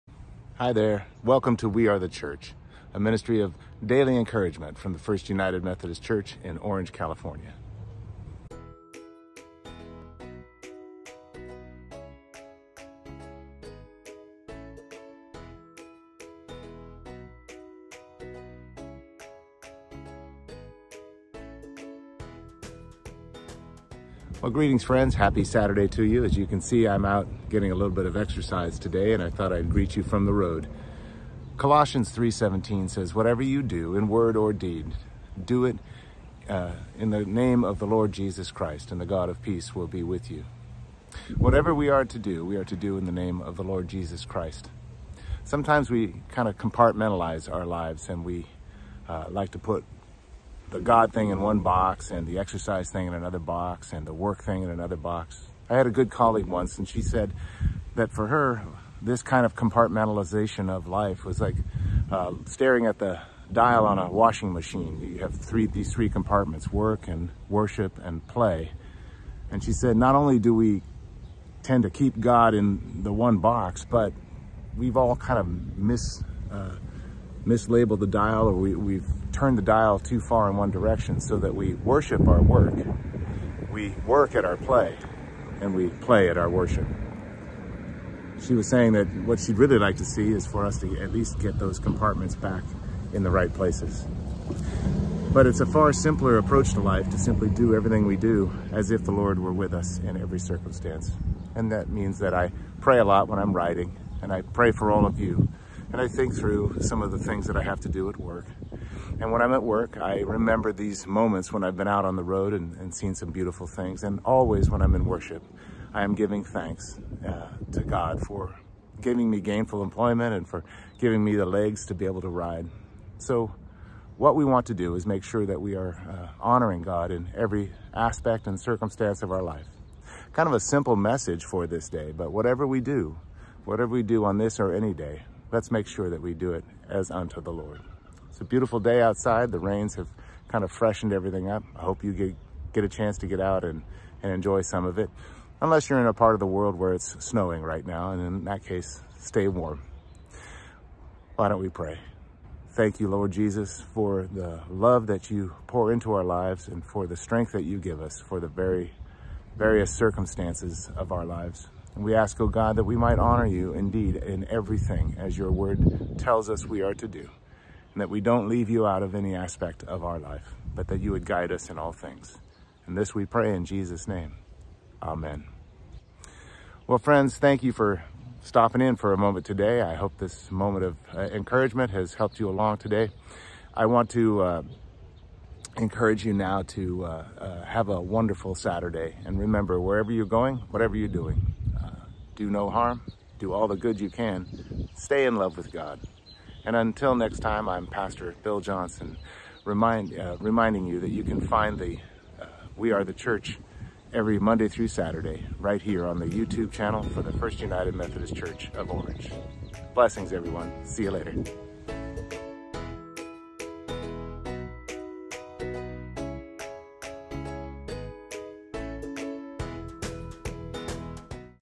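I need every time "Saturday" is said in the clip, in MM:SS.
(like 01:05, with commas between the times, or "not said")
00:25, 03:08, 03:24.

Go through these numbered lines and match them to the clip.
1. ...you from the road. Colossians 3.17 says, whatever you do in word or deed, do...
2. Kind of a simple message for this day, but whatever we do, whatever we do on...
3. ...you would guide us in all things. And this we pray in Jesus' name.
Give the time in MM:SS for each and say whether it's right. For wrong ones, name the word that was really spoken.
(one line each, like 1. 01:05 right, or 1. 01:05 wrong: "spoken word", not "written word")
1. 00:29 right
2. 02:10 right
3. 02:51 right.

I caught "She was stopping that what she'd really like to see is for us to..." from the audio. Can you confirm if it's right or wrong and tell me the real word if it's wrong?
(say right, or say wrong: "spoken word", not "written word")
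wrong: "saying", not "stopping".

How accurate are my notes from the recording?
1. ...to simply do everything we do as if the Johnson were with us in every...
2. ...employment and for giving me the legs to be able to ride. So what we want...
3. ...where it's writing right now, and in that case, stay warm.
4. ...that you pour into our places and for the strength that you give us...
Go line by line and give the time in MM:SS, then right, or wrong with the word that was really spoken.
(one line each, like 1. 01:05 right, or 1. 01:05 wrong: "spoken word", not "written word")
1. 01:37 wrong: "Lord", not "Johnson"
2. 01:59 right
3. 02:26 wrong: "snowing", not "writing"
4. 02:35 wrong: "lives", not "places".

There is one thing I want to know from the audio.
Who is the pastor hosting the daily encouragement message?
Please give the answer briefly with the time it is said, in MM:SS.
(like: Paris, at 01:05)
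Bill Johnson, at 03:18.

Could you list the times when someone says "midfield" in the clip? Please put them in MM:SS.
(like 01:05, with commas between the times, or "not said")
not said.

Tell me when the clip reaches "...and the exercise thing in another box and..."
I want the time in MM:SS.
00:52.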